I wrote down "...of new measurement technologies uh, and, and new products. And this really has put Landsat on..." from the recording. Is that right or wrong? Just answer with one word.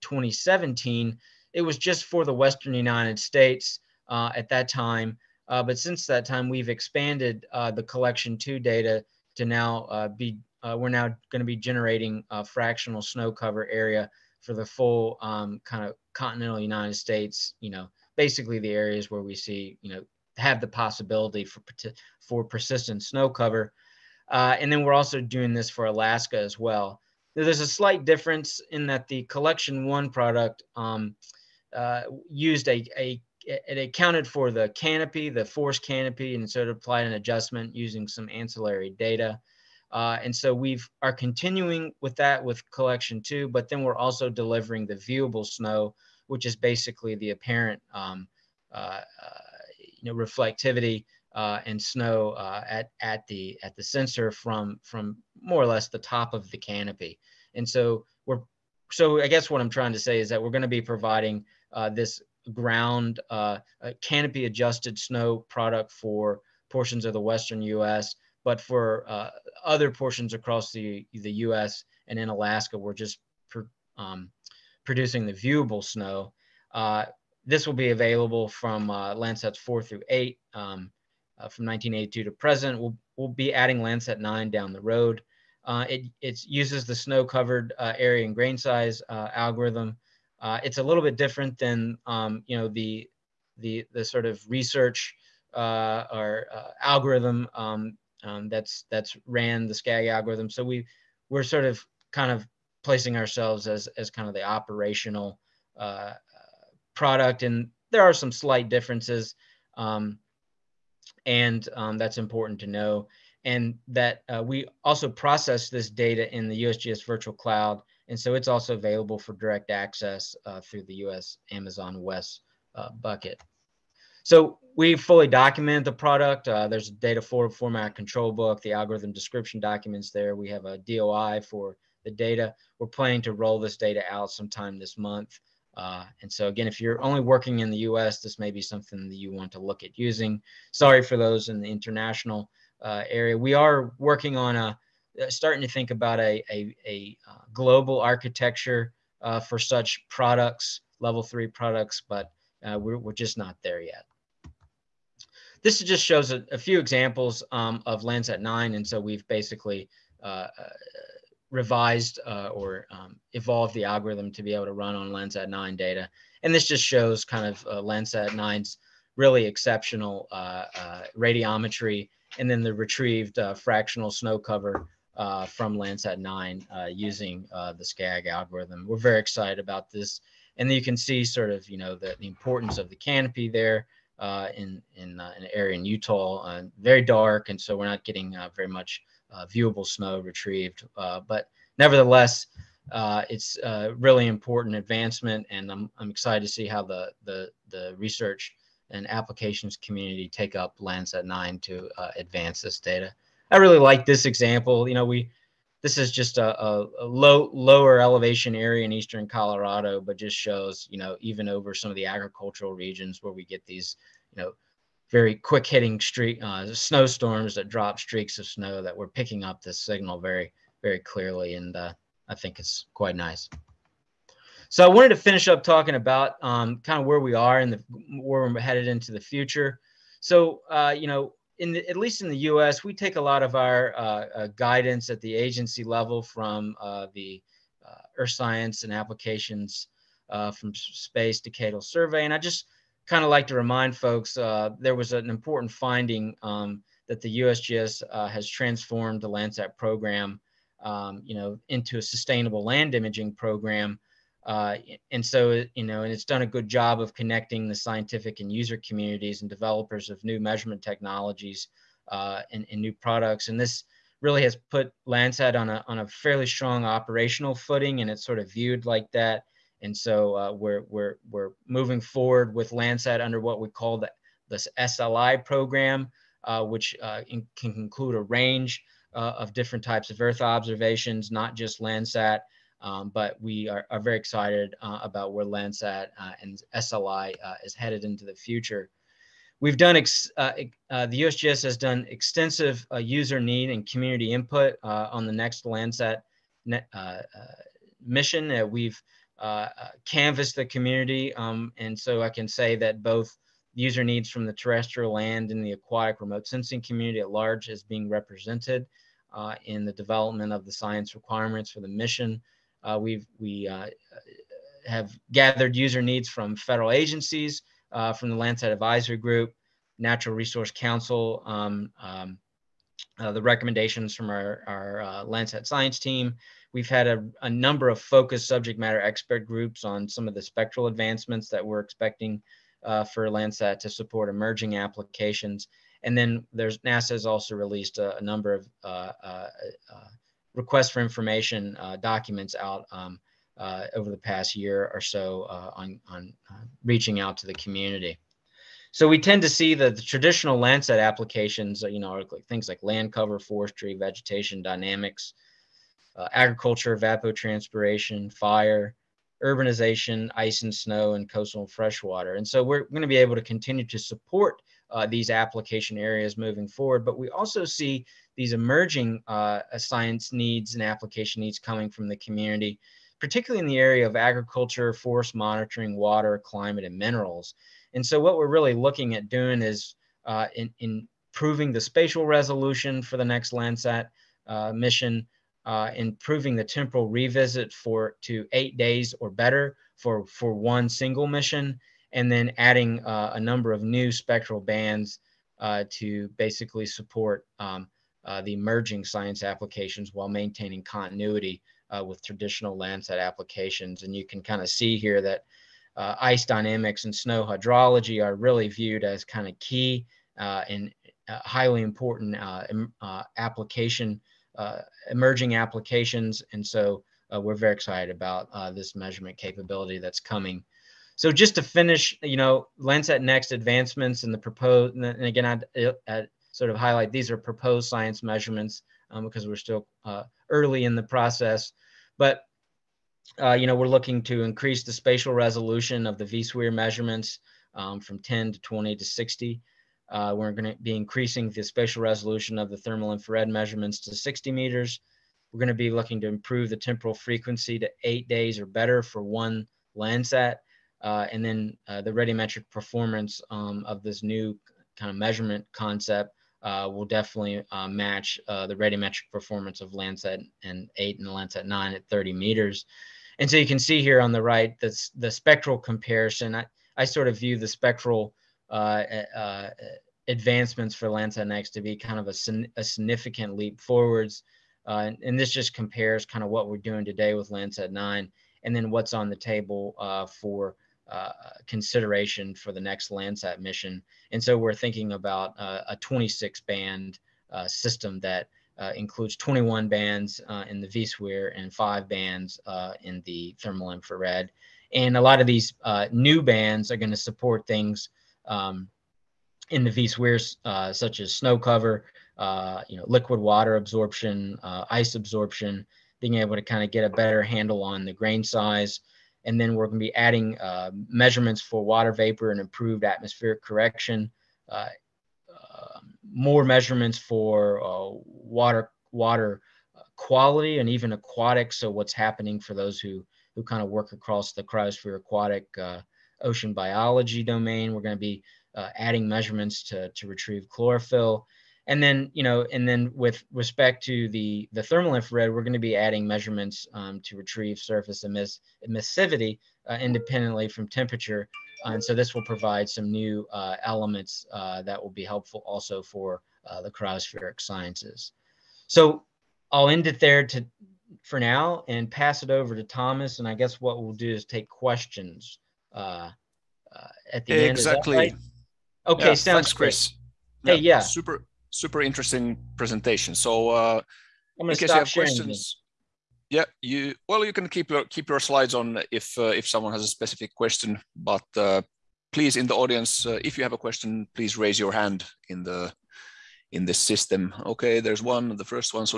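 right.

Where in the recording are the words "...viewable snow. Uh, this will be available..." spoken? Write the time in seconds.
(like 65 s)
75 s.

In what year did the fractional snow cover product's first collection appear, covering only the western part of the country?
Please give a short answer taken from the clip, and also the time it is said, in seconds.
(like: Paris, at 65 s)
2017, at 0 s.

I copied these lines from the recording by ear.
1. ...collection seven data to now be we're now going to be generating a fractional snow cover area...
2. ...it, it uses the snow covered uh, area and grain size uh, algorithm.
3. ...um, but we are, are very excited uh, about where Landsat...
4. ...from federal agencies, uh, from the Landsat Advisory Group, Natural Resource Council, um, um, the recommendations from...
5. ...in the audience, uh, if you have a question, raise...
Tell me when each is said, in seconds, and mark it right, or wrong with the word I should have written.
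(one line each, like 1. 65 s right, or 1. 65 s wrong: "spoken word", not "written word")
1. 7 s wrong: "two", not "seven"
2. 85 s right
3. 282 s right
4. 316 s right
5. 572 s wrong: "please", not "raise".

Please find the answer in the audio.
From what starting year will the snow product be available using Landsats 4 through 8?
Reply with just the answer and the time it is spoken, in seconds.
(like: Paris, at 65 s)
1982, at 81 s.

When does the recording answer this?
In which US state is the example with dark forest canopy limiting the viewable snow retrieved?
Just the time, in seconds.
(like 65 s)
185 s.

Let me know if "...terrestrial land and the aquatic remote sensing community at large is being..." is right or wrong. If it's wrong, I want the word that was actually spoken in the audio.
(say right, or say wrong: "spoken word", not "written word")
right.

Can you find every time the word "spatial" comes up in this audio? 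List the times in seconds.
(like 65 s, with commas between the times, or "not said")
381 s, 434 s, 441 s.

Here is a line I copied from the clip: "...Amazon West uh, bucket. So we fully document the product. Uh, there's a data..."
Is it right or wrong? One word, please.
right.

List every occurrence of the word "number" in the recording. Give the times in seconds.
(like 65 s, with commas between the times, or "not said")
327 s, 338 s, 393 s.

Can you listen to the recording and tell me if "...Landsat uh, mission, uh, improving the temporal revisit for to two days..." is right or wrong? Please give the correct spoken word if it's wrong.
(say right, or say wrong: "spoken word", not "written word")
wrong: "eight", not "two".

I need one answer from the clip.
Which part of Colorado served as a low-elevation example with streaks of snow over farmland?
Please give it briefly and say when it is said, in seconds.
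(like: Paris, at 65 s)
eastern Colorado, at 208 s.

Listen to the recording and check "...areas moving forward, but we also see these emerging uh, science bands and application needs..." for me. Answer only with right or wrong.
wrong.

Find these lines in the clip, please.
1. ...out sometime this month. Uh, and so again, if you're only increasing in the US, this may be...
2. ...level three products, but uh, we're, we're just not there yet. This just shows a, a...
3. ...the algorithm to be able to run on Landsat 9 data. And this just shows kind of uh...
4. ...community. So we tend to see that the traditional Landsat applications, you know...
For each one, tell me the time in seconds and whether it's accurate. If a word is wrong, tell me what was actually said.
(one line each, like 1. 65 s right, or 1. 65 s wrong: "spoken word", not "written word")
1. 134 s wrong: "working", not "increasing"
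2. 150 s right
3. 163 s right
4. 347 s right.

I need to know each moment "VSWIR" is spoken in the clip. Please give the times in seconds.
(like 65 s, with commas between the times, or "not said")
436 s, 490 s.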